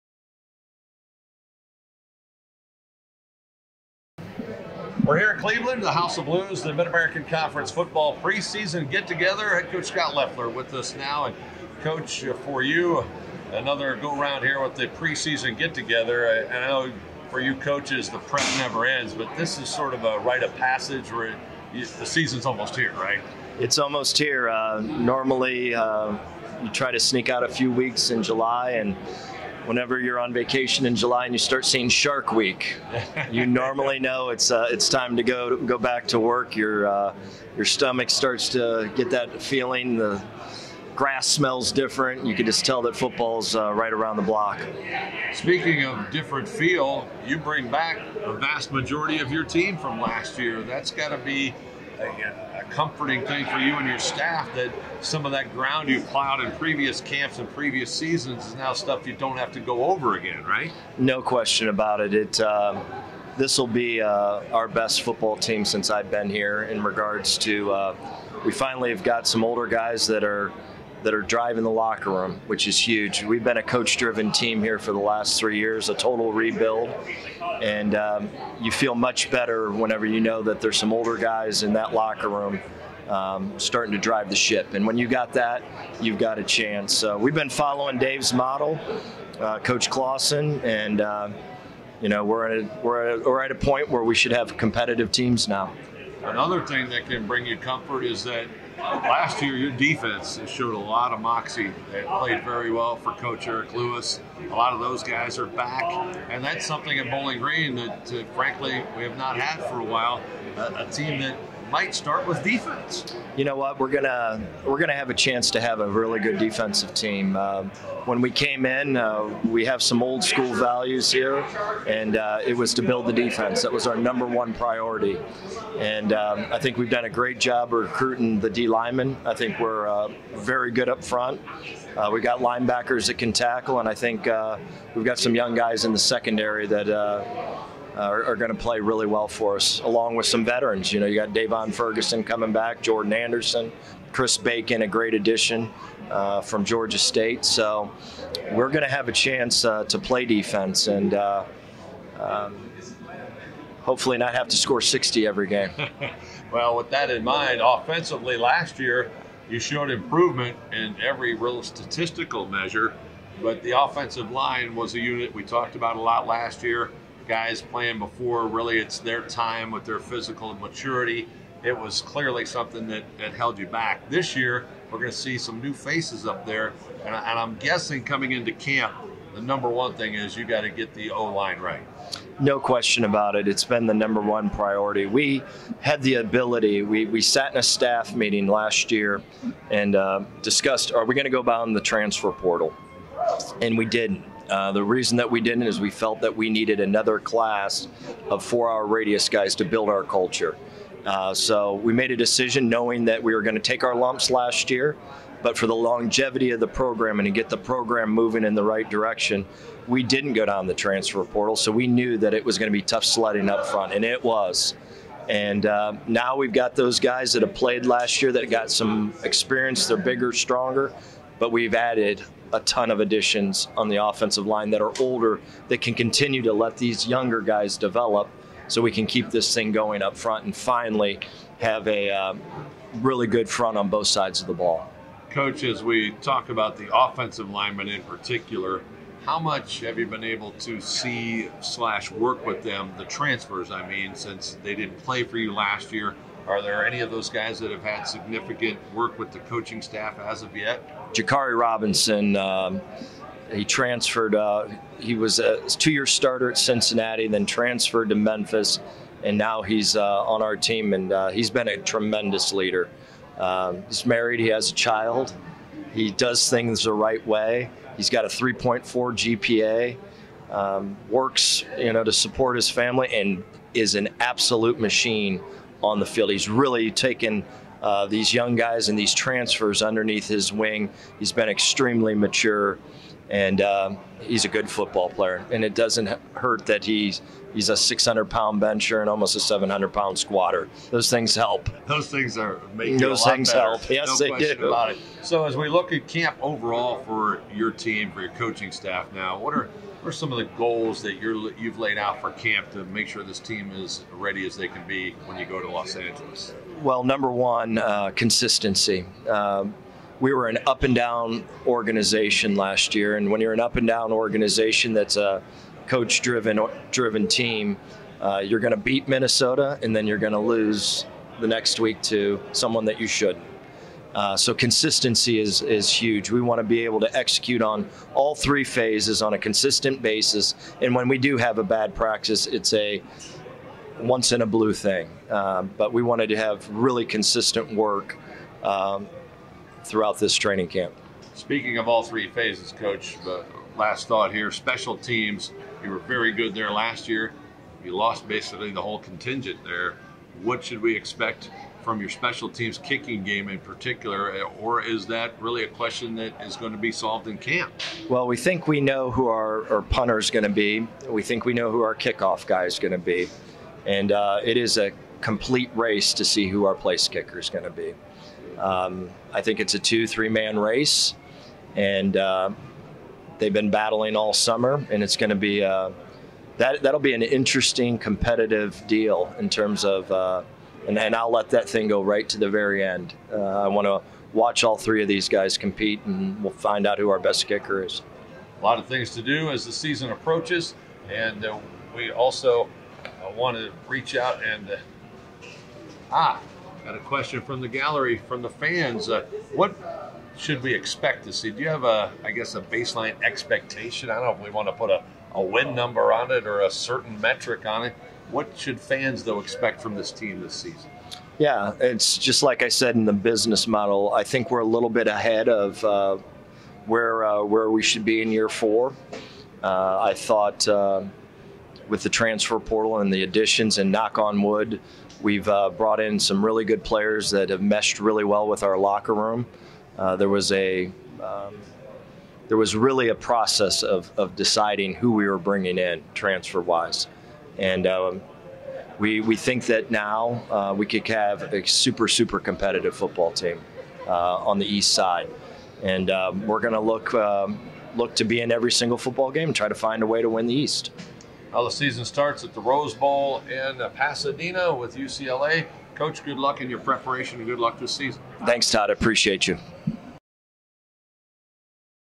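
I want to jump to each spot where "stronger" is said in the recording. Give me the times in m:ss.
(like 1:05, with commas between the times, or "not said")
3:40.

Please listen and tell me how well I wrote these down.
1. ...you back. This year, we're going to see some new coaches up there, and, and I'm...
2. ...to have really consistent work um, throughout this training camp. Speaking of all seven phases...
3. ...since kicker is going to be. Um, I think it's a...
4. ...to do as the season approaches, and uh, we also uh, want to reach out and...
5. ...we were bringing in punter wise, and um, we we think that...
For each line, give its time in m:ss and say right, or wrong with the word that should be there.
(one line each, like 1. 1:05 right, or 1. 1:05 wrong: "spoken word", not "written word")
1. 2:53 wrong: "faces", not "coaches"
2. 5:36 wrong: "three", not "seven"
3. 6:06 wrong: "place", not "since"
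4. 6:29 right
5. 7:15 wrong: "transfer", not "punter".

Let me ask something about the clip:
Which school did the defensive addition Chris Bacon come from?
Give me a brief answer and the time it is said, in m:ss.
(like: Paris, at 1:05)
Georgia State, at 2:26.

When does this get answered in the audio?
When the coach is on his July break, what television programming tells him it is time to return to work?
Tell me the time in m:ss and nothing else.
0:31.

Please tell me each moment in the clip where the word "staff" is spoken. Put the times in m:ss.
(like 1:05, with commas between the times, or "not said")
0:53, 3:07, 4:09, 4:58.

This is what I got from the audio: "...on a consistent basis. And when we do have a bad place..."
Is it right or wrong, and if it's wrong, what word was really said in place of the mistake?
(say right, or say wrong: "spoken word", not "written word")
wrong: "practice", not "place".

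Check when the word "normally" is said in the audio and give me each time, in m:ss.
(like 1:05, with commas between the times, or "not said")
0:24, 0:33.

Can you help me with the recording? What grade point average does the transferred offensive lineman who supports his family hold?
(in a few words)
3.4.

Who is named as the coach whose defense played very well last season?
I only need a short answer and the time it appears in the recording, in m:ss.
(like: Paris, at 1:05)
Eric Lewis, at 1:43.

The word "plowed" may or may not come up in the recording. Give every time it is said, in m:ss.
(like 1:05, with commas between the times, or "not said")
0:56.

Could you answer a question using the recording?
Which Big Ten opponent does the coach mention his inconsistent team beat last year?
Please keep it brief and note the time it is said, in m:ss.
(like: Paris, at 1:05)
Minnesota, at 5:19.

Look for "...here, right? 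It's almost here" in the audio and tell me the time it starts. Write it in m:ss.
0:22.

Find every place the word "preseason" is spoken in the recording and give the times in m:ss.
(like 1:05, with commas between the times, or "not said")
0:08, 0:14.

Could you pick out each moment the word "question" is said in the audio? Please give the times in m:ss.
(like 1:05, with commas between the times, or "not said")
1:01, 3:02, 5:55, 6:36.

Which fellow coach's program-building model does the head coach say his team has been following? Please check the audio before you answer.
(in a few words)
Coach Clawson.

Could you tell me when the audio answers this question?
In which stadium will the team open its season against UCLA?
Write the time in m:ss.
7:32.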